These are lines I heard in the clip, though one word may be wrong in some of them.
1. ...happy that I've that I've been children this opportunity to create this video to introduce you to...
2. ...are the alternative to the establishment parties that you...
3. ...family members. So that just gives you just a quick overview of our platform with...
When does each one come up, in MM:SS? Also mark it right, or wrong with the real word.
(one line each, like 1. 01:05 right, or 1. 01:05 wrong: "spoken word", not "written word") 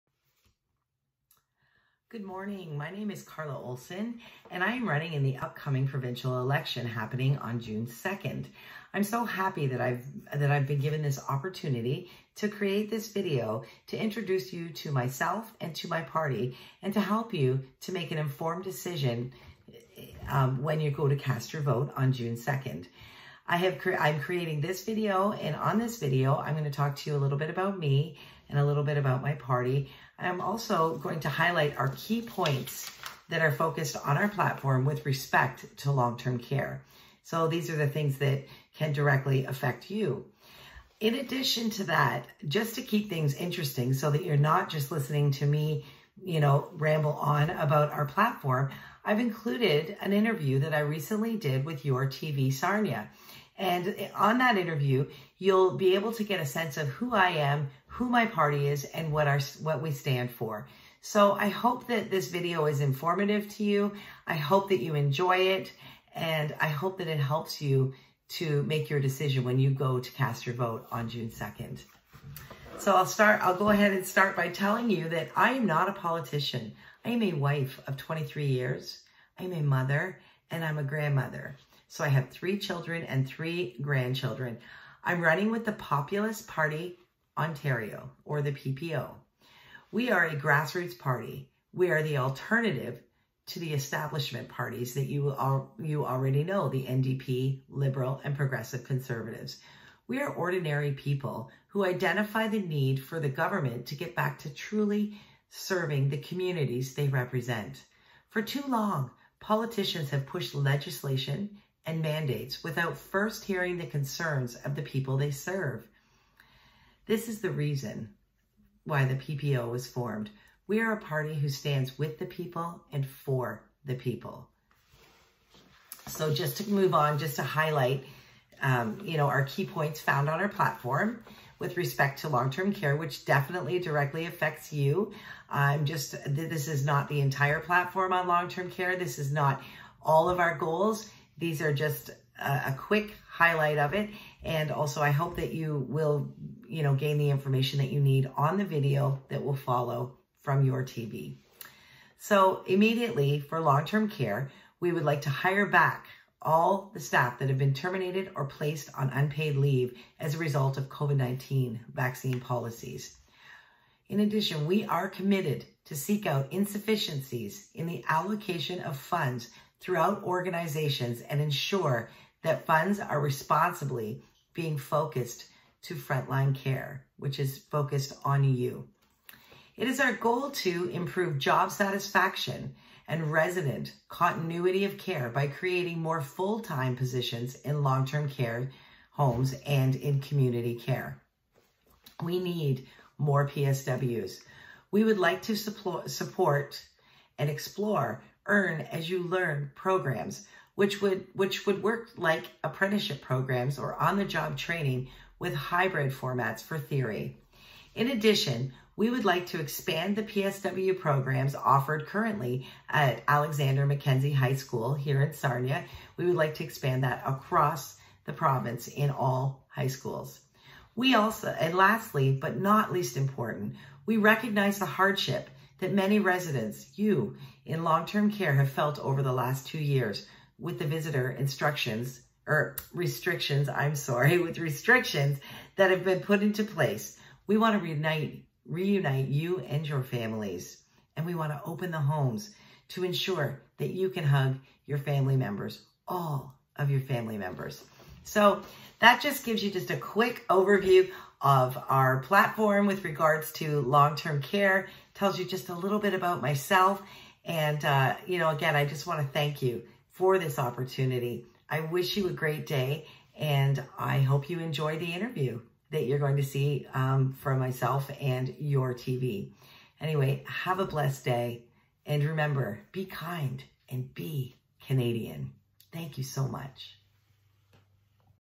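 1. 00:09 wrong: "given", not "children"
2. 01:31 right
3. 04:07 right.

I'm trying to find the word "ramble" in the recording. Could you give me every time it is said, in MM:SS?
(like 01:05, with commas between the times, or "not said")
00:46.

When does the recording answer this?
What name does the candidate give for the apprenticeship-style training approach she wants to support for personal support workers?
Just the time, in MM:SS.
03:18.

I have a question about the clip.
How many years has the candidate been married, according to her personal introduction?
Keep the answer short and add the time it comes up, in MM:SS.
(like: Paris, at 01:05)
23, at 01:17.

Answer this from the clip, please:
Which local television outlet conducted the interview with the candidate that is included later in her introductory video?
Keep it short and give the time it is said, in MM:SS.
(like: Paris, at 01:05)
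Your TV Sarnia, at 00:51.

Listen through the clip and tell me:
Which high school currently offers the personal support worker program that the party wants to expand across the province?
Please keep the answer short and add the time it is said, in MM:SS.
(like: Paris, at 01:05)
Alexander Mackenzie High School, at 03:33.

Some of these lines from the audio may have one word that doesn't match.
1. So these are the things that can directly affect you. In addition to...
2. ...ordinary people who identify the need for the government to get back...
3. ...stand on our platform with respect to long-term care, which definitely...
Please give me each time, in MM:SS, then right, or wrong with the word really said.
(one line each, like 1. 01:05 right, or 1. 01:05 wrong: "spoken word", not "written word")
1. 00:37 right
2. 01:40 right
3. 02:09 wrong: "found", not "stand".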